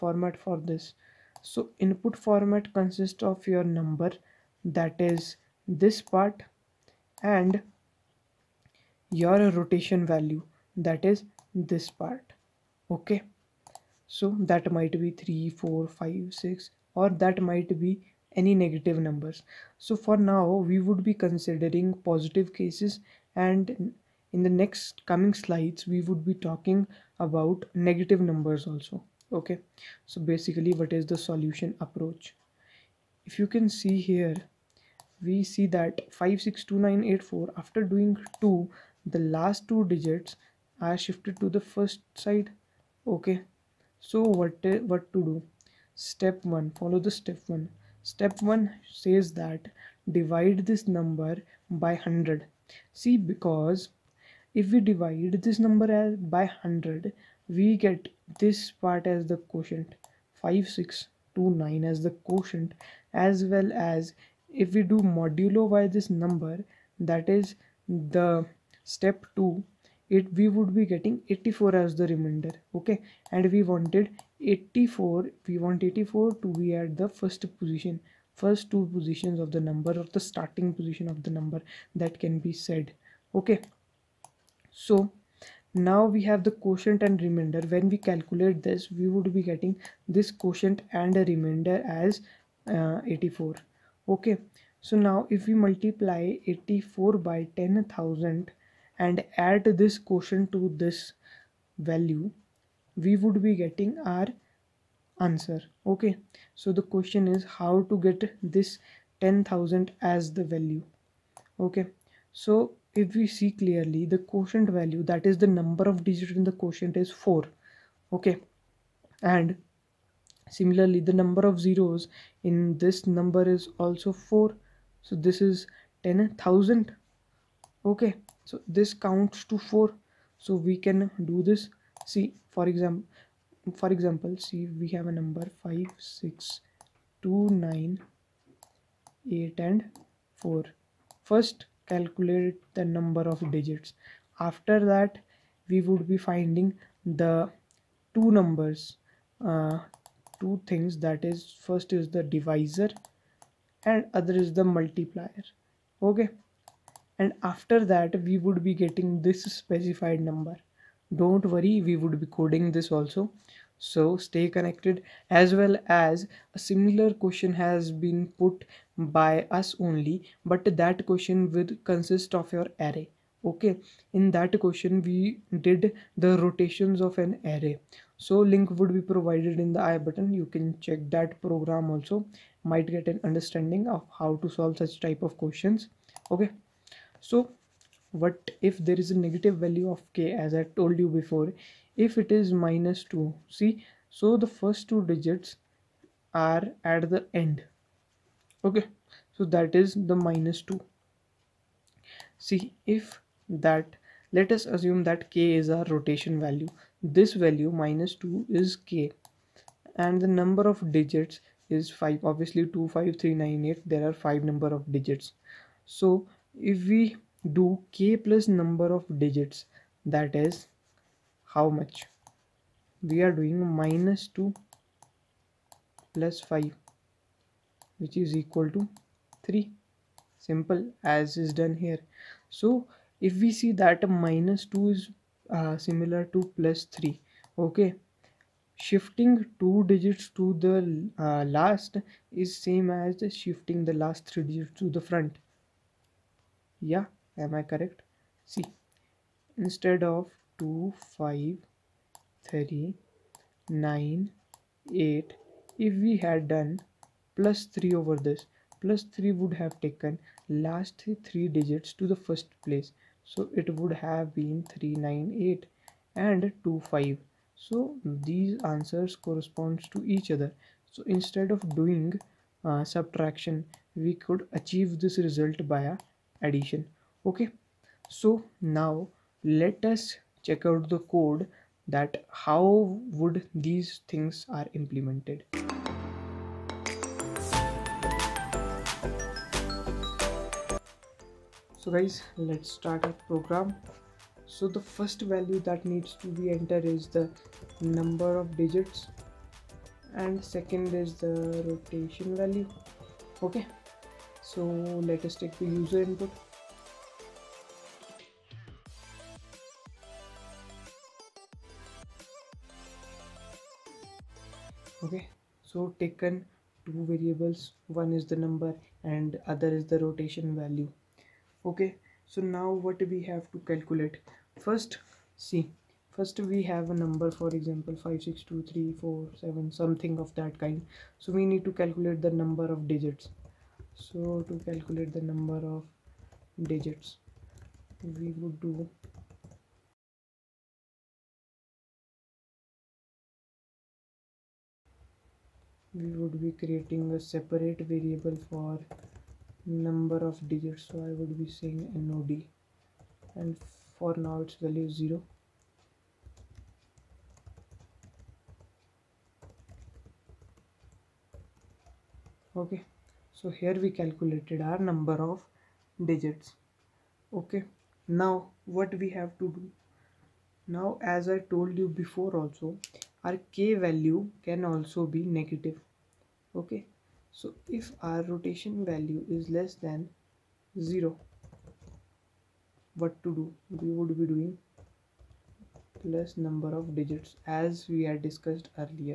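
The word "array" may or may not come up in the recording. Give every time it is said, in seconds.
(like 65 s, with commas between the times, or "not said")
172 s, 177 s.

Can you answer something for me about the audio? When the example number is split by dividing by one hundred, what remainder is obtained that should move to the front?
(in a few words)
84.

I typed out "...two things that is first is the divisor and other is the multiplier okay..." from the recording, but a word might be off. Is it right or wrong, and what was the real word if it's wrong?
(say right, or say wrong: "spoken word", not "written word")
right.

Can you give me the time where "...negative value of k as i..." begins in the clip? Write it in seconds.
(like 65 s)
189 s.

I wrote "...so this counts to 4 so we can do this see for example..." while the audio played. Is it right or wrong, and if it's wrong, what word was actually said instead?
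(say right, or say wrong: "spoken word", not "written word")
right.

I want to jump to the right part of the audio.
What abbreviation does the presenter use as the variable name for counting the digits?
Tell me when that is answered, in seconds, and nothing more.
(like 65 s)
351 s.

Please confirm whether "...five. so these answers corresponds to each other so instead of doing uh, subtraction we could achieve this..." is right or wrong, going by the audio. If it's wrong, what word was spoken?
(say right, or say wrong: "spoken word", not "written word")
right.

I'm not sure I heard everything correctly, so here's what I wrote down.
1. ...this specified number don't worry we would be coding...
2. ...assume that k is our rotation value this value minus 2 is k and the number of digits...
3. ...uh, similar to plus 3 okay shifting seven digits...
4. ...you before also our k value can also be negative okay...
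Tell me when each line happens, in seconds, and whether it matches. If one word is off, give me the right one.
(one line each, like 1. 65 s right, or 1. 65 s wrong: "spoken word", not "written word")
1. 159 s right
2. 204 s right
3. 235 s wrong: "two", not "seven"
4. 371 s right.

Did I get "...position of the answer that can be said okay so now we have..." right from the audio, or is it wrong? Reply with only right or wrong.
wrong.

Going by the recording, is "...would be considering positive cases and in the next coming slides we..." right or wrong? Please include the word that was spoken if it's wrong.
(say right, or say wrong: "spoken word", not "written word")
right.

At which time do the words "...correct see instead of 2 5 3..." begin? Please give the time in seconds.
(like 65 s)
247 s.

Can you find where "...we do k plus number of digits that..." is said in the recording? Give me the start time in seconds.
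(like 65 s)
216 s.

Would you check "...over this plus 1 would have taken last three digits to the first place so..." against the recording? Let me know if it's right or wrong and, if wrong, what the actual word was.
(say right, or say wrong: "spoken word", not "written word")
wrong: "3", not "1".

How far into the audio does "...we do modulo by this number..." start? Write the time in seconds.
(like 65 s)
64 s.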